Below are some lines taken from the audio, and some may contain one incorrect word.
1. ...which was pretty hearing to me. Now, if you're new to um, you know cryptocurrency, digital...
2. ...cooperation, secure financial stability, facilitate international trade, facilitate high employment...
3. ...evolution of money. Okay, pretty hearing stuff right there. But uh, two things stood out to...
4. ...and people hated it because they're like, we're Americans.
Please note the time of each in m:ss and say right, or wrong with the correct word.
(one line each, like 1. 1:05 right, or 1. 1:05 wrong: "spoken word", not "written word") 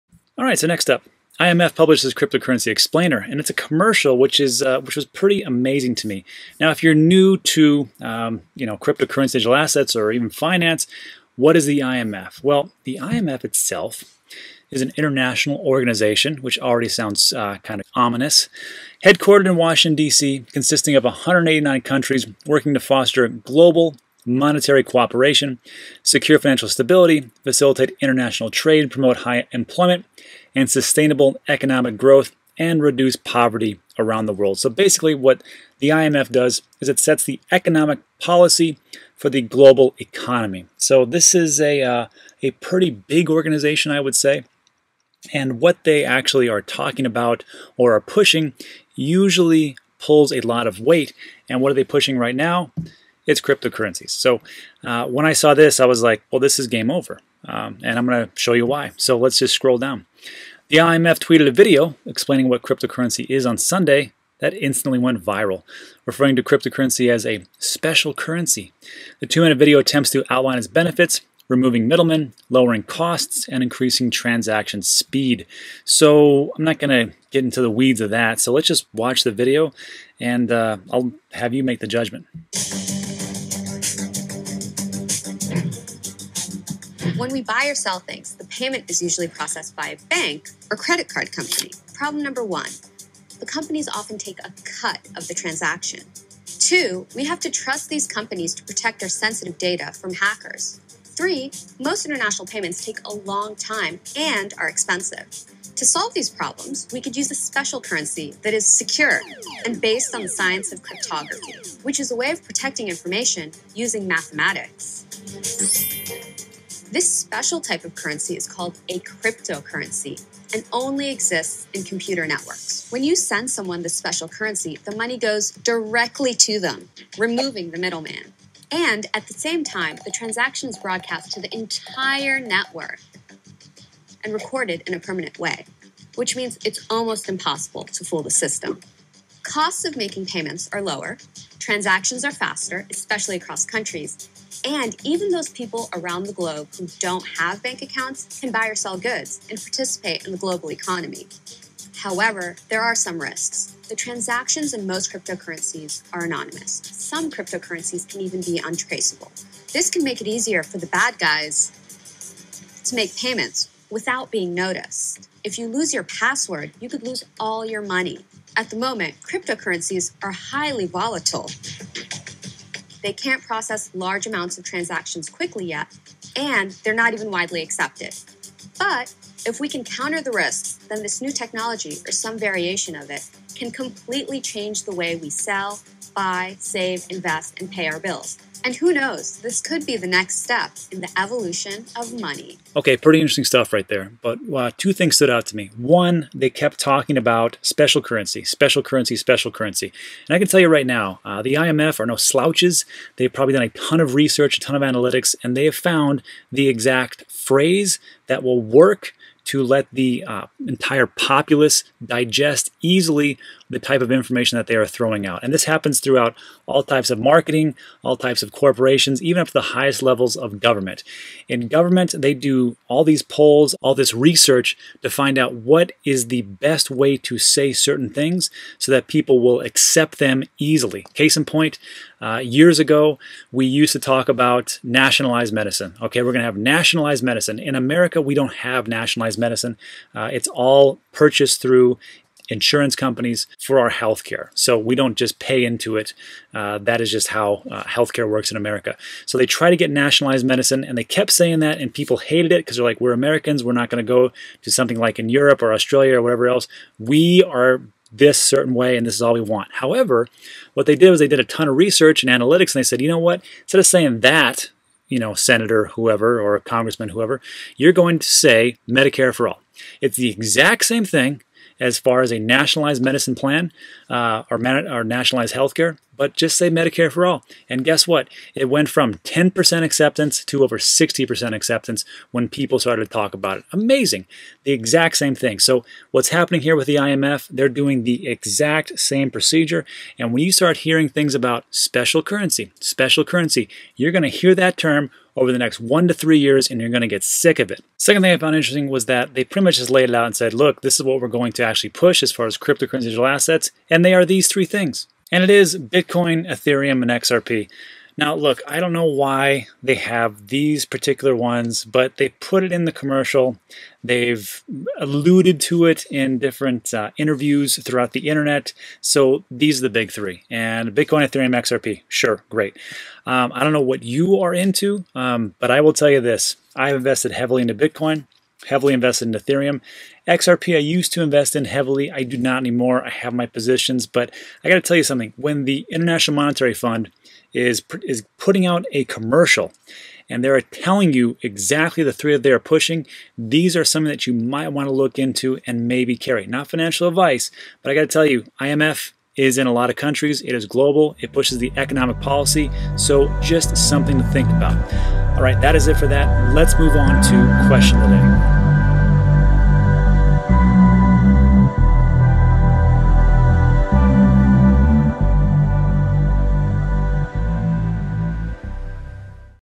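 1. 0:04 wrong: "amazing", not "hearing"
2. 0:24 wrong: "promote", not "facilitate"
3. 3:11 wrong: "interesting", not "hearing"
4. 4:11 right.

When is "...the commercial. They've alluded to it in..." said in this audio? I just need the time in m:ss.
5:12.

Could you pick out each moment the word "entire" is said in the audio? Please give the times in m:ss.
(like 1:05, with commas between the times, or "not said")
2:11, 3:30.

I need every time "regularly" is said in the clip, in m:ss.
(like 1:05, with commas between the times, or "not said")
not said.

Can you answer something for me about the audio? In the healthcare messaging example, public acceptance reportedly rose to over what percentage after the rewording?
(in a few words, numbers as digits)
60%.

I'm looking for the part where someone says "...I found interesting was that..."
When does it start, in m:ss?
4:58.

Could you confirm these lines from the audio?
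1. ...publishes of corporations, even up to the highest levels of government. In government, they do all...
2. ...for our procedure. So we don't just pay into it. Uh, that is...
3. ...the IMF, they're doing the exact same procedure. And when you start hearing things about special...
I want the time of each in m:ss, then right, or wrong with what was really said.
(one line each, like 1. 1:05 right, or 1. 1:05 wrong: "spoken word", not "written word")
1. 3:38 wrong: "types", not "publishes"
2. 4:03 wrong: "healthcare", not "procedure"
3. 4:46 right.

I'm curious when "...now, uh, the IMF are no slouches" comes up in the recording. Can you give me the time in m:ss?
3:20.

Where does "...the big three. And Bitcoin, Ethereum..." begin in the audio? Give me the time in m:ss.
5:19.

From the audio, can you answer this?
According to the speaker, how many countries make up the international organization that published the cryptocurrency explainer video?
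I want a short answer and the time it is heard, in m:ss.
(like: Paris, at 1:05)
189, at 0:21.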